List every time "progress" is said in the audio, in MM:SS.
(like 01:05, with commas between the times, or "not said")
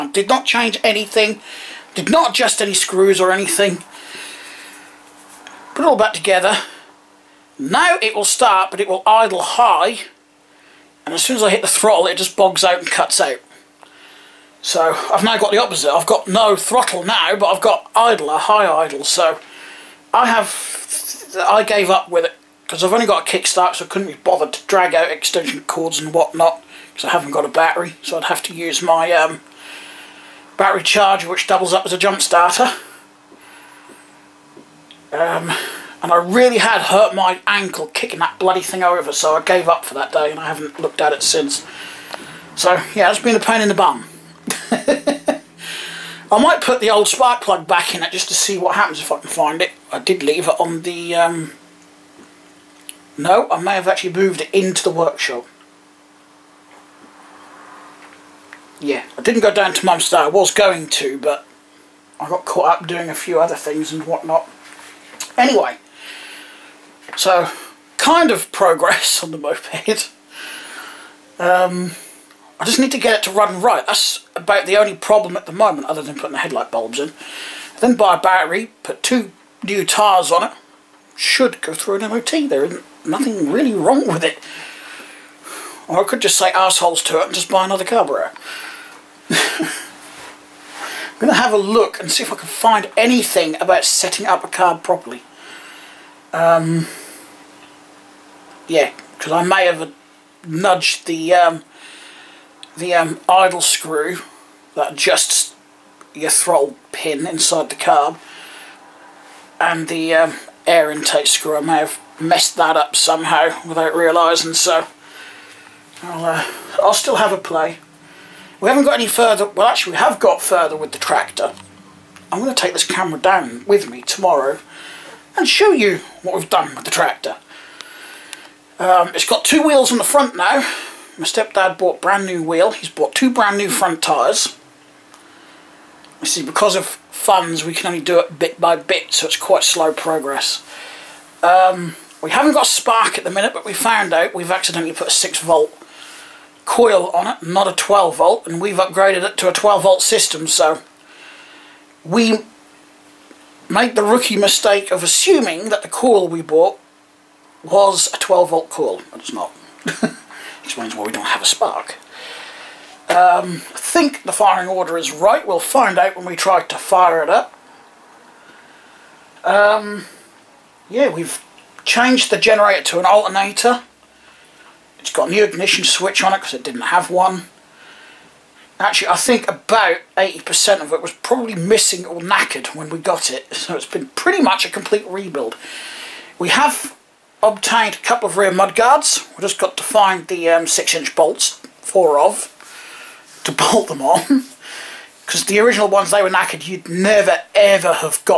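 01:08, 02:19.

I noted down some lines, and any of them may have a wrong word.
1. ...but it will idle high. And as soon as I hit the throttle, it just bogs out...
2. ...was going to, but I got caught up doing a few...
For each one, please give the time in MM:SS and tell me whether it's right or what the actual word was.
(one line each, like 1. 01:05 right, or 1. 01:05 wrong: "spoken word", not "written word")
1. 00:08 right
2. 01:00 right.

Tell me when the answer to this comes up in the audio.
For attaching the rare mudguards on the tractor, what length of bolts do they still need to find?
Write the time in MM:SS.
03:10.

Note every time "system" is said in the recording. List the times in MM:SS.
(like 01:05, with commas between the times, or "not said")
02:30.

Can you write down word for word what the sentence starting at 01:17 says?
Then buy a battery, put two new tyres on it.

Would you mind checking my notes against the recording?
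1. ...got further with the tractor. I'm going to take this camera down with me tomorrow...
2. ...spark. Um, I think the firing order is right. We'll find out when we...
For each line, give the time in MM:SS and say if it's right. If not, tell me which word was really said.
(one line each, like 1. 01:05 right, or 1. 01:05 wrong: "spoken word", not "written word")
1. 02:00 right
2. 02:41 right.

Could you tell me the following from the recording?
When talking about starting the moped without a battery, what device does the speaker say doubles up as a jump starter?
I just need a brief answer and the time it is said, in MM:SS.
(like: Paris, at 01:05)
battery charger, at 00:30.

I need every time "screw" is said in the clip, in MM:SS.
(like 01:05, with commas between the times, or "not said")
00:02, 01:43, 01:51.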